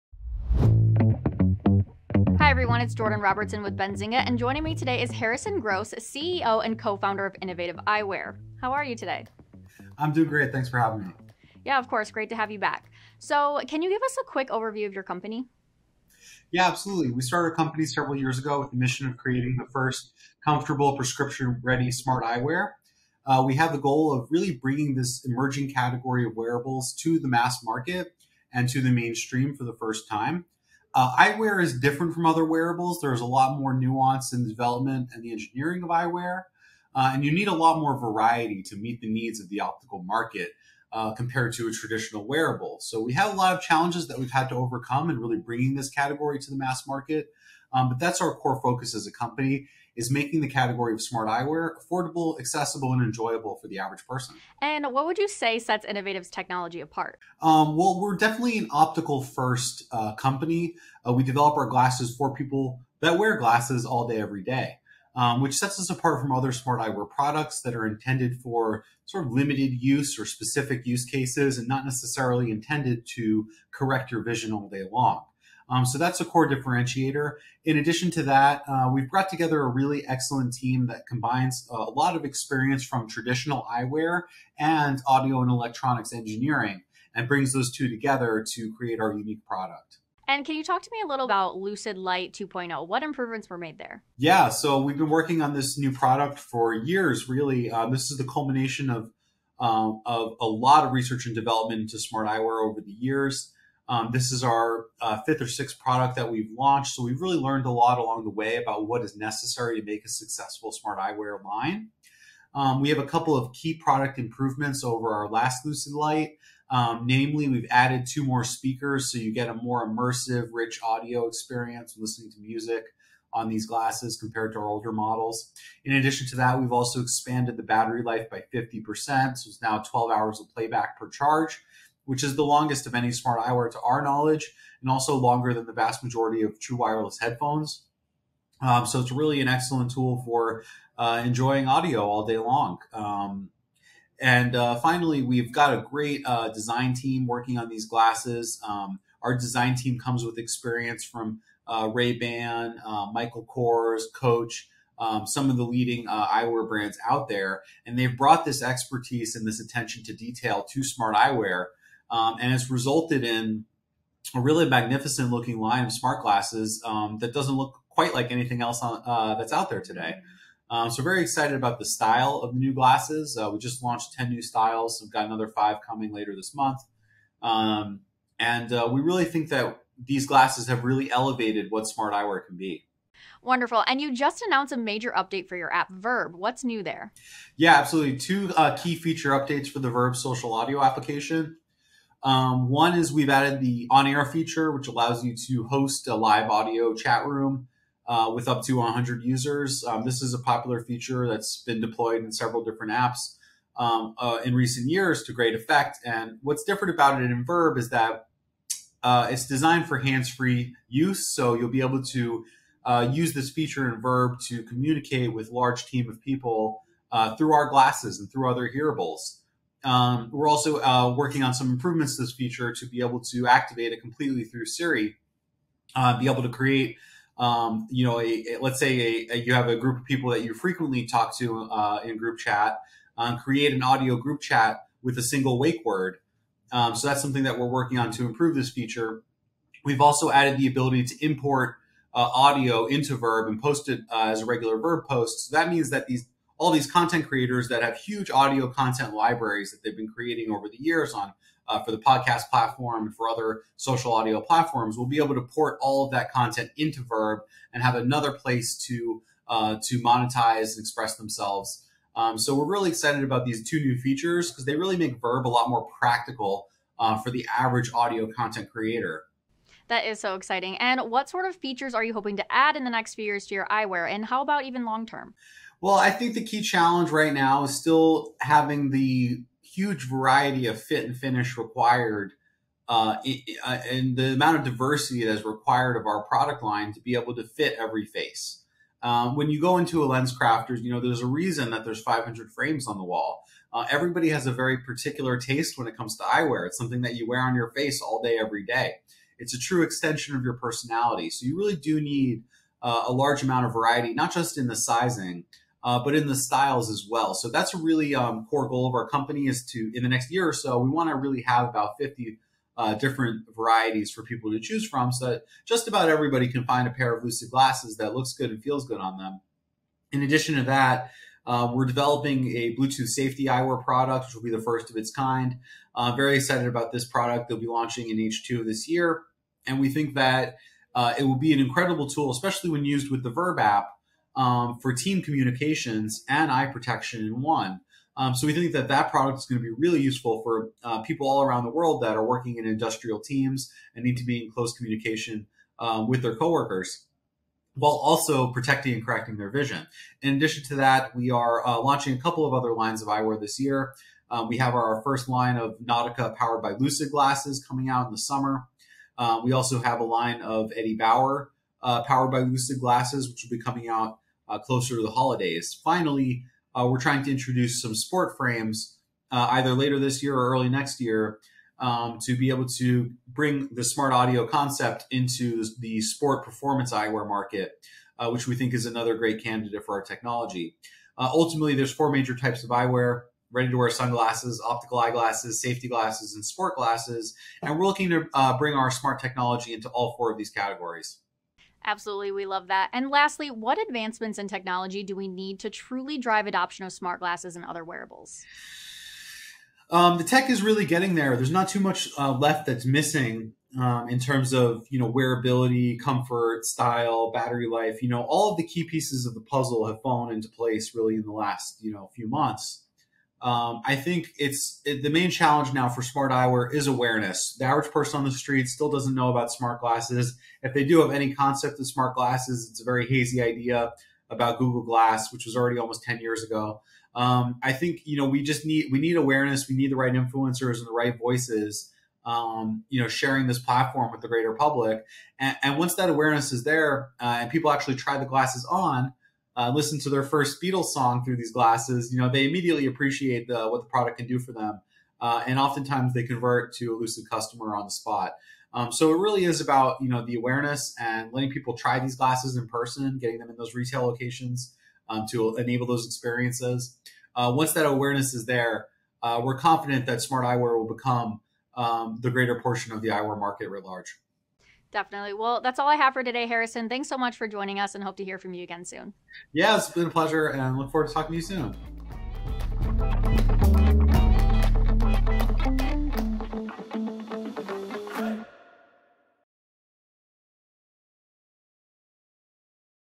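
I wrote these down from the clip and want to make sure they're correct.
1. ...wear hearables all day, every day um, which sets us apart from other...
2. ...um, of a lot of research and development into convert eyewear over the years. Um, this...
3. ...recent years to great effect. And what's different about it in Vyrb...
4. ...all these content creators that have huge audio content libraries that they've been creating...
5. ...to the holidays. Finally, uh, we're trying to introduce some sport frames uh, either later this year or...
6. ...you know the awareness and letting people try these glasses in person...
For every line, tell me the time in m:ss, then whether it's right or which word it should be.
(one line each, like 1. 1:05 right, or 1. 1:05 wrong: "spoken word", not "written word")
1. 1:03 wrong: "glasses", not "hearables"
2. 1:39 wrong: "smart", not "convert"
3. 3:24 right
4. 4:06 right
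5. 6:04 right
6. 7:30 right.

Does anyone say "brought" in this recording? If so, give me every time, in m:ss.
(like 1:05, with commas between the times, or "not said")
1:19, 2:38.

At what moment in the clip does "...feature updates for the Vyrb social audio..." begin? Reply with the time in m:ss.
3:08.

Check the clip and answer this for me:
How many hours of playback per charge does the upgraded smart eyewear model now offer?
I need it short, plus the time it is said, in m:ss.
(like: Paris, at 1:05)
12, at 2:09.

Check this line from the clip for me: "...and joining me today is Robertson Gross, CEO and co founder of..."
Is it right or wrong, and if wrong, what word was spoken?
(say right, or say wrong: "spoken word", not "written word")
wrong: "Harrison", not "Robertson".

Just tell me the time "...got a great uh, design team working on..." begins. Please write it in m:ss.
2:25.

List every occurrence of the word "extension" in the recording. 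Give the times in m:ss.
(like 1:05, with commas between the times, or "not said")
4:59.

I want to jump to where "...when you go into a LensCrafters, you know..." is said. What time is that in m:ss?
4:49.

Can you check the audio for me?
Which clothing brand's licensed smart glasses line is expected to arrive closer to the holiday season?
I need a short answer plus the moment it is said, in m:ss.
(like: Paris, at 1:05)
Eddie Bauer, at 6:00.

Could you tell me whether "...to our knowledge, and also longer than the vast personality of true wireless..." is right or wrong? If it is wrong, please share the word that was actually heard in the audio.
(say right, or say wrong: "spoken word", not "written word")
wrong: "majority", not "personality".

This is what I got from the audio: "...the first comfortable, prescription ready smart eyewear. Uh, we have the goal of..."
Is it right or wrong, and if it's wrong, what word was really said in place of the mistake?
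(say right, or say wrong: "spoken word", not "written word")
right.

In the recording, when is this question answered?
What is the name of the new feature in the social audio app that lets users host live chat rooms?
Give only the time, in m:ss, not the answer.
3:13.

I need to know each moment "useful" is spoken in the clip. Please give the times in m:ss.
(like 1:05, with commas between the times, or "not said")
5:40.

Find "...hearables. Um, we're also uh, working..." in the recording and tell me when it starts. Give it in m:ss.
3:38.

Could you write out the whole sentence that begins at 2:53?
Uh, we just launched 10 new styles.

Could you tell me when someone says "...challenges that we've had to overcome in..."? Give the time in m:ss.
0:43.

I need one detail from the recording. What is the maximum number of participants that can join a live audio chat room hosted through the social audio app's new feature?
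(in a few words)
100.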